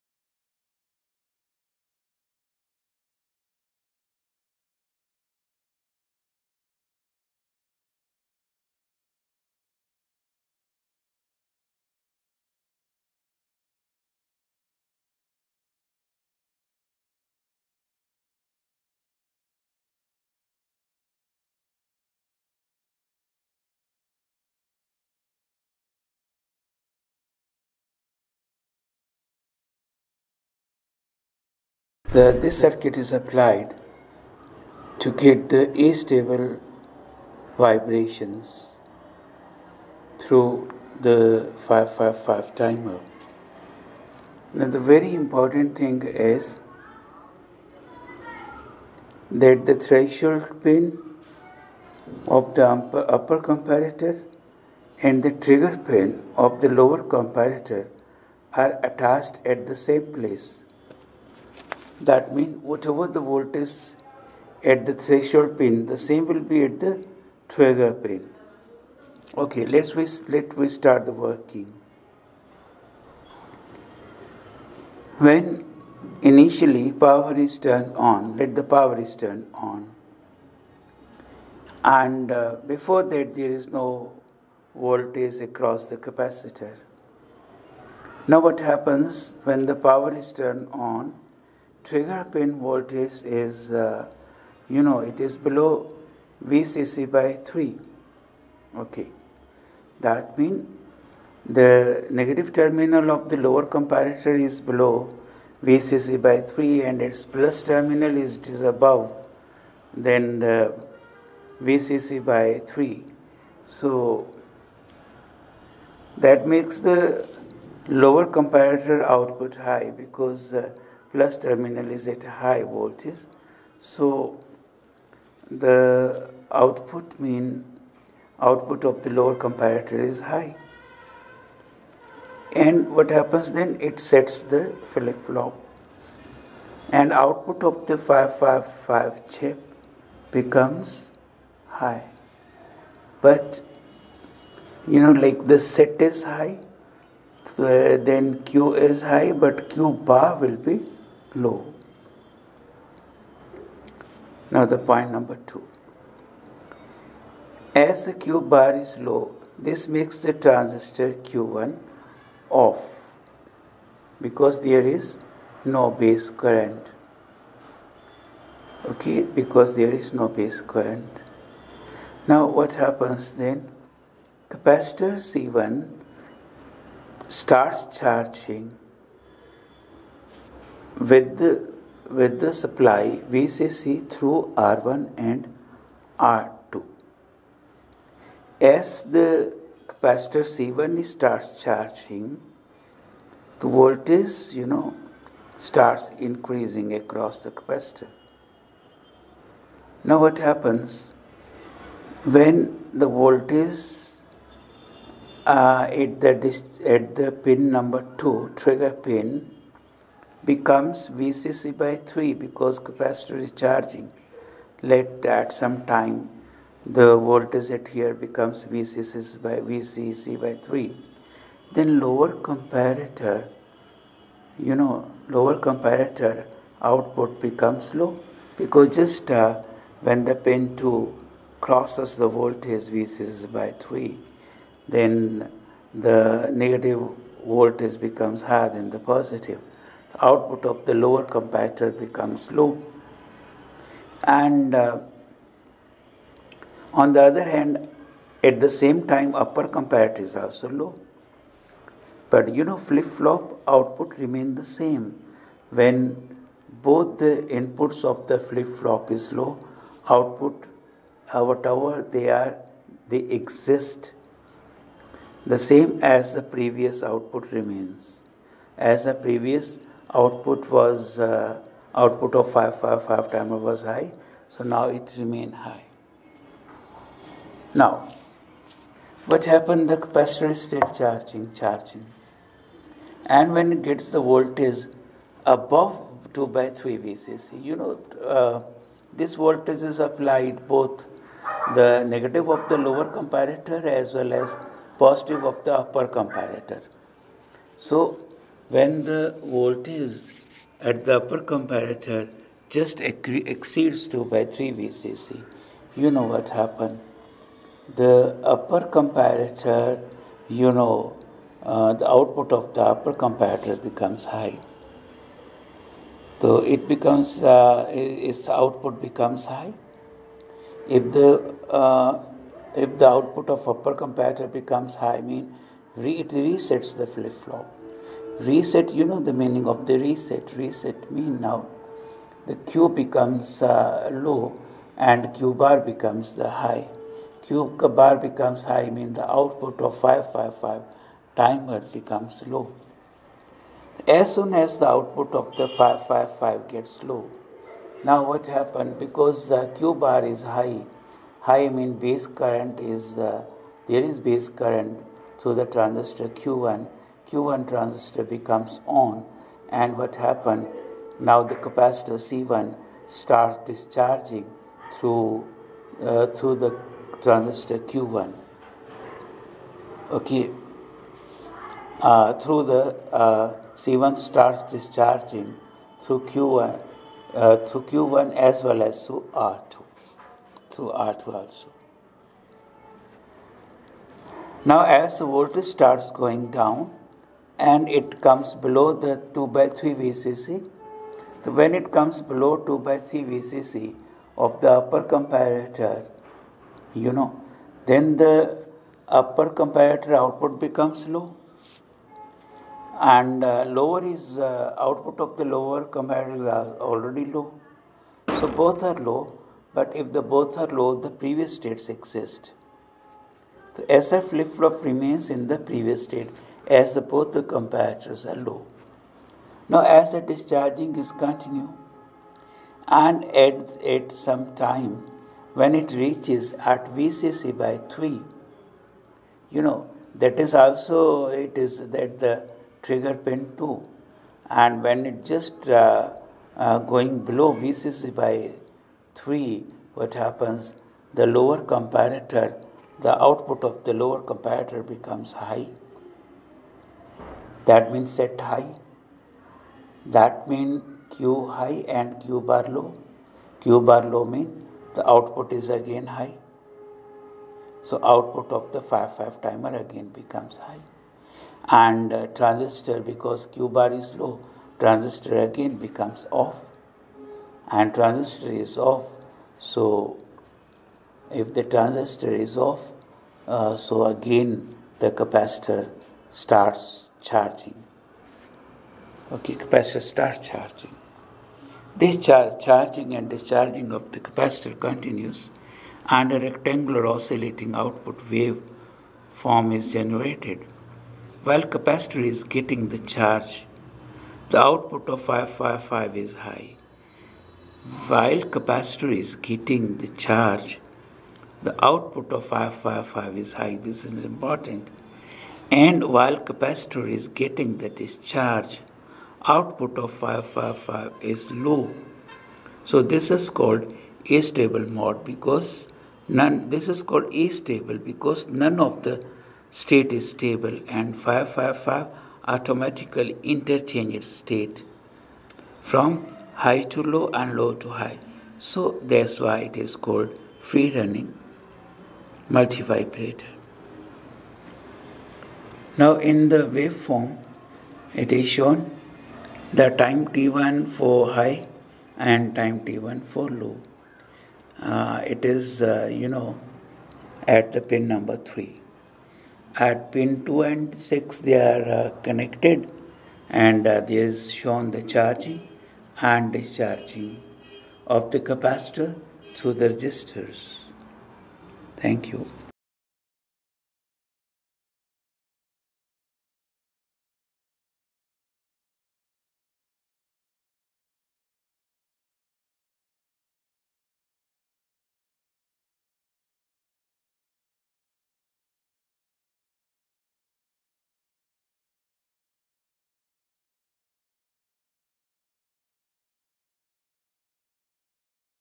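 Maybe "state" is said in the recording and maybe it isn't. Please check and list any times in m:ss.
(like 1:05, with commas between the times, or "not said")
6:51, 6:56, 8:39, 8:44.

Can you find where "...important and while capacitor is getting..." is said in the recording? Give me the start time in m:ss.
8:24.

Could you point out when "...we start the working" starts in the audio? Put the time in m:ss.
1:10.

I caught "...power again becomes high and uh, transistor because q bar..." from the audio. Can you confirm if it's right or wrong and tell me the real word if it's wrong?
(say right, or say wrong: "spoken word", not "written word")
wrong: "timer", not "power".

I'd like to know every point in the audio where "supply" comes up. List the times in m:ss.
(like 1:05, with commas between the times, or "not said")
3:02.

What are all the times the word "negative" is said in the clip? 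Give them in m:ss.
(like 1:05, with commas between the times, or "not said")
1:42, 3:56, 4:52.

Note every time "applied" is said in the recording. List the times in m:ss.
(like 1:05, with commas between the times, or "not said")
0:33, 4:49.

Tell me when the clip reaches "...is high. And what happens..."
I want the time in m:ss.
2:09.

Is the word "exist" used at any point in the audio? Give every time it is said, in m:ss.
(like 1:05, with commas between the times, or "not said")
4:23, 6:51.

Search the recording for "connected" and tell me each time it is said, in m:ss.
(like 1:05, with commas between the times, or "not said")
9:12.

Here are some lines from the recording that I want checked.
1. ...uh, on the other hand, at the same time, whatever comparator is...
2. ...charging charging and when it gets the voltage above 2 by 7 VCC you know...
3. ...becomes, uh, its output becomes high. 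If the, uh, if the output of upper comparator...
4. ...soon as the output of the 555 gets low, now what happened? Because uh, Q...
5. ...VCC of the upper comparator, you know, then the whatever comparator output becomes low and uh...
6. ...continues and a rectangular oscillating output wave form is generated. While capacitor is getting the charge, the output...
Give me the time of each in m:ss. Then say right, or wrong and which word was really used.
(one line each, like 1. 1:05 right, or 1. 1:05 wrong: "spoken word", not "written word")
1. 4:04 wrong: "upper", not "whatever"
2. 4:41 wrong: "3", not "7"
3. 5:16 right
4. 5:44 right
5. 6:33 wrong: "upper", not "whatever"
6. 8:04 right.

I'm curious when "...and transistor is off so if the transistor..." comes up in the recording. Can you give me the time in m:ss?
7:47.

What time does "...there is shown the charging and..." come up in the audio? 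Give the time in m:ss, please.
9:13.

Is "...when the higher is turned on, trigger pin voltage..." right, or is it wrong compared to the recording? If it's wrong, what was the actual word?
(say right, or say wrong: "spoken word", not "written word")
wrong: "power", not "higher".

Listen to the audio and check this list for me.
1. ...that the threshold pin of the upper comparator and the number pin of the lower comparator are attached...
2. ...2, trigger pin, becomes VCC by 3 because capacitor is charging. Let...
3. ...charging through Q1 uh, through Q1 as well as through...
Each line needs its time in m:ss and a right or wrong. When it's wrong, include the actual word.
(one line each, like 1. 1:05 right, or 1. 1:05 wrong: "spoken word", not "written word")
1. 0:49 wrong: "trigger", not "number"
2. 3:28 right
3. 6:14 wrong: "discharging", not "charging".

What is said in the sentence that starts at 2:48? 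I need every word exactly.
Okay, because there is no base current.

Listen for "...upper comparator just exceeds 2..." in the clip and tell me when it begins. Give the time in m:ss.
5:01.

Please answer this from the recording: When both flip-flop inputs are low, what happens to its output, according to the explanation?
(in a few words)
previous output remains.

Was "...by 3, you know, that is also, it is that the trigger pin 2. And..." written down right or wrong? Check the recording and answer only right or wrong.
right.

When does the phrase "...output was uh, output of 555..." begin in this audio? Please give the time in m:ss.
4:30.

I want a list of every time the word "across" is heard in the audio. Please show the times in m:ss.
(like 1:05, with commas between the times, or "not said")
1:25, 3:16.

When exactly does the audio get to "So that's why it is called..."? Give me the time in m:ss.
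8:48.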